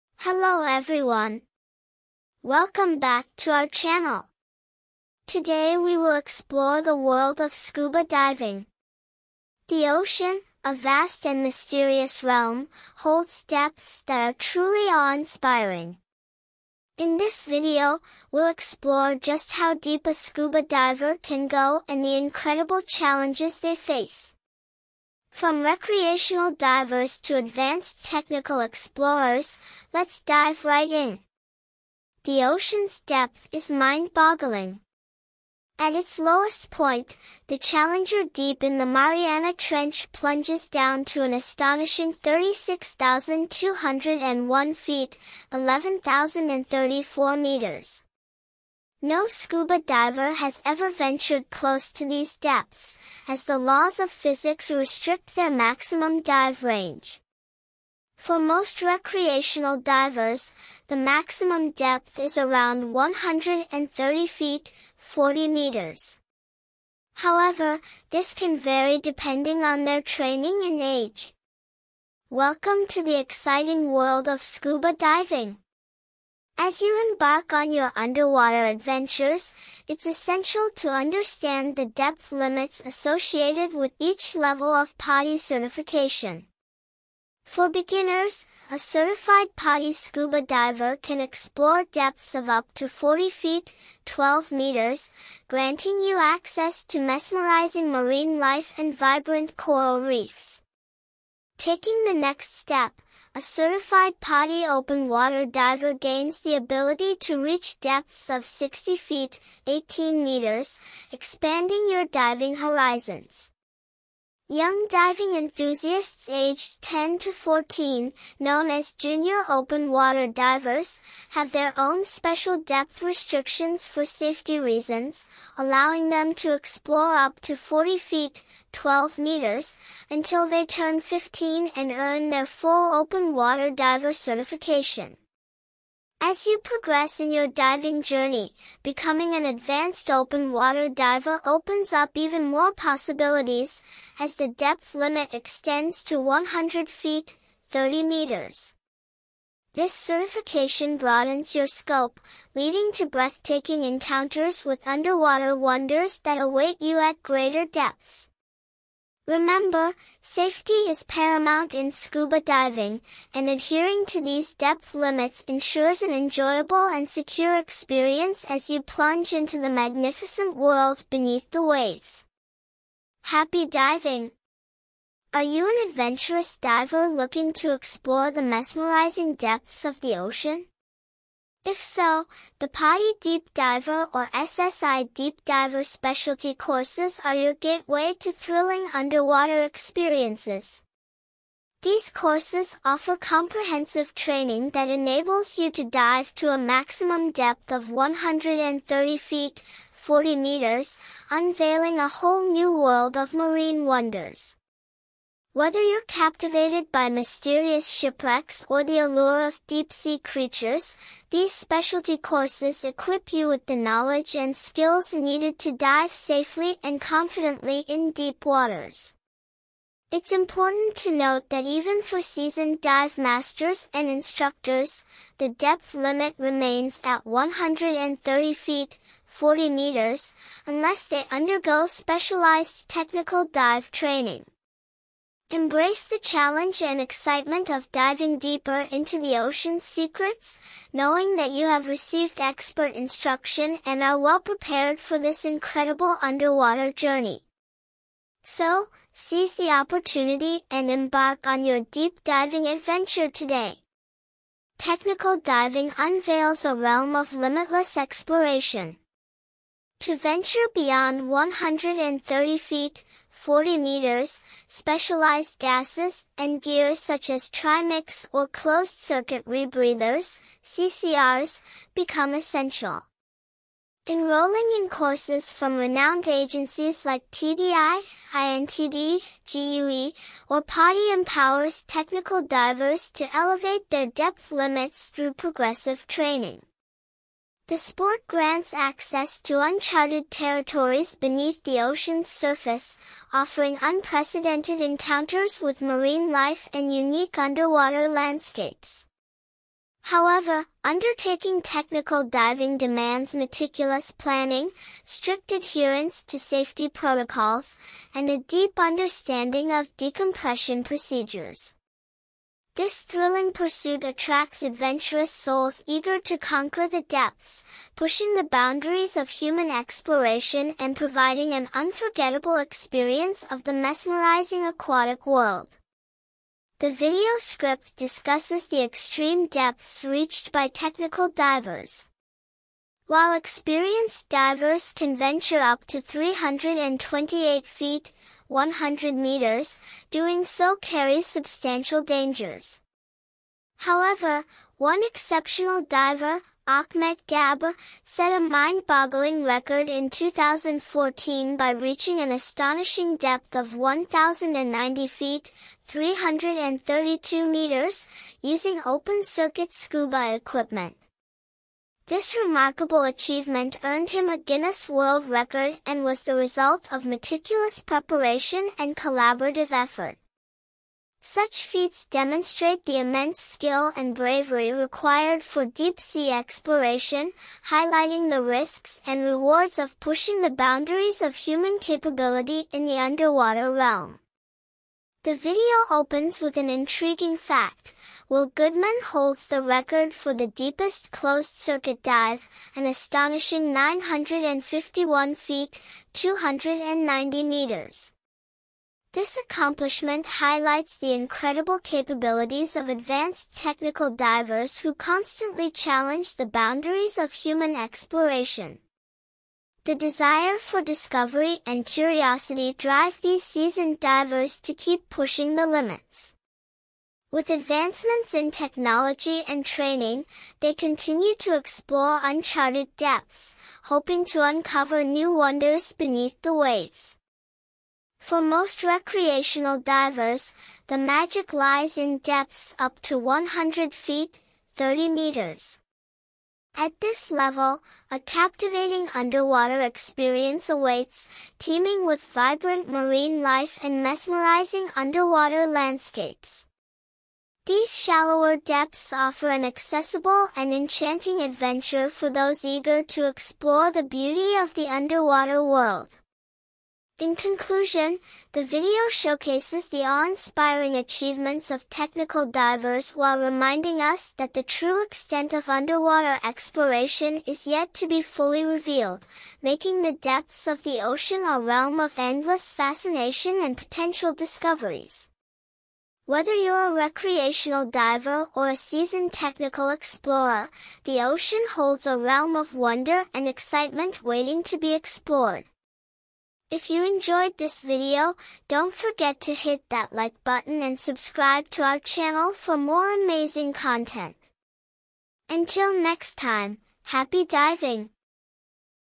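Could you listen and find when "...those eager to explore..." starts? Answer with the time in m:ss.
7:32.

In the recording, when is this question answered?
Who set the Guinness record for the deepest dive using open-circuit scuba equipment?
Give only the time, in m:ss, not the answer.
5:46.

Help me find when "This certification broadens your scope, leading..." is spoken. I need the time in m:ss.
2:29.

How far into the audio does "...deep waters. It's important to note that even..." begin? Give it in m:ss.
3:38.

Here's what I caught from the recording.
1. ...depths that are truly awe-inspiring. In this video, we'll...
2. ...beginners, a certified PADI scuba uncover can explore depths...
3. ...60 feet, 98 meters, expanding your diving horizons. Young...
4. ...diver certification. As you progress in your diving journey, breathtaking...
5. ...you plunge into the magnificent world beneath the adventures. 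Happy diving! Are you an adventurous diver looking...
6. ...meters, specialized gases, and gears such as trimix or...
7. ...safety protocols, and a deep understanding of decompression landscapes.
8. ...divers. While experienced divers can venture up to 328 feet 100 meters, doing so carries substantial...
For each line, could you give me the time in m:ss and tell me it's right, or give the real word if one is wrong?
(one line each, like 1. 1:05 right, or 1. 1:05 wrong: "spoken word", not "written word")
1. 0:13 right
2. 1:27 wrong: "diver", not "uncover"
3. 1:48 wrong: "18", not "98"
4. 2:13 wrong: "becoming", not "breathtaking"
5. 2:48 wrong: "waves", not "adventures"
6. 4:23 right
7. 5:06 wrong: "procedures", not "landscapes"
8. 5:31 right.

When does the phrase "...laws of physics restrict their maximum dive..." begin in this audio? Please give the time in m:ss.
0:53.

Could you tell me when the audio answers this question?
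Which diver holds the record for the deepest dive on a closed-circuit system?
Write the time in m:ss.
6:28.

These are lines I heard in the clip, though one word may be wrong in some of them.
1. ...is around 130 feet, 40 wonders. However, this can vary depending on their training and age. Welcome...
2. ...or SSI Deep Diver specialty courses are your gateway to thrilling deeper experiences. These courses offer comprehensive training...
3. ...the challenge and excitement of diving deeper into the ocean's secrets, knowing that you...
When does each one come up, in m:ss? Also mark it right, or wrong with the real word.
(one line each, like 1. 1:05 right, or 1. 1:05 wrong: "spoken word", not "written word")
1. 1:02 wrong: "meters", not "wonders"
2. 3:04 wrong: "underwater", not "deeper"
3. 3:56 right.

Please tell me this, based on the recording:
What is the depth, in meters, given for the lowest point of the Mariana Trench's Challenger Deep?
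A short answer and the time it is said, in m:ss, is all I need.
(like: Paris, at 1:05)
11,034 meters, at 0:45.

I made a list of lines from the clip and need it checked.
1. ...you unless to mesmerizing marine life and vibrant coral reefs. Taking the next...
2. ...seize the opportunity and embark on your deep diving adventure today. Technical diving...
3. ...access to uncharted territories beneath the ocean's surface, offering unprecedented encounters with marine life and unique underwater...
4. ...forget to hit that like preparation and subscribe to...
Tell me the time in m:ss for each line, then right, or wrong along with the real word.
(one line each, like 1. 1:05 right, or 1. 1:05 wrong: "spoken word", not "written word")
1. 1:36 wrong: "access", not "unless"
2. 4:09 right
3. 4:48 right
4. 8:08 wrong: "button", not "preparation".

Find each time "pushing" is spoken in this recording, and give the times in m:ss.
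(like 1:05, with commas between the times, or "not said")
5:17, 6:20, 6:55.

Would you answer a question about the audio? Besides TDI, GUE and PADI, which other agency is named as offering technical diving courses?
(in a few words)
IANTD.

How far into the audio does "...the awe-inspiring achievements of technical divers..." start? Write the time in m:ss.
7:39.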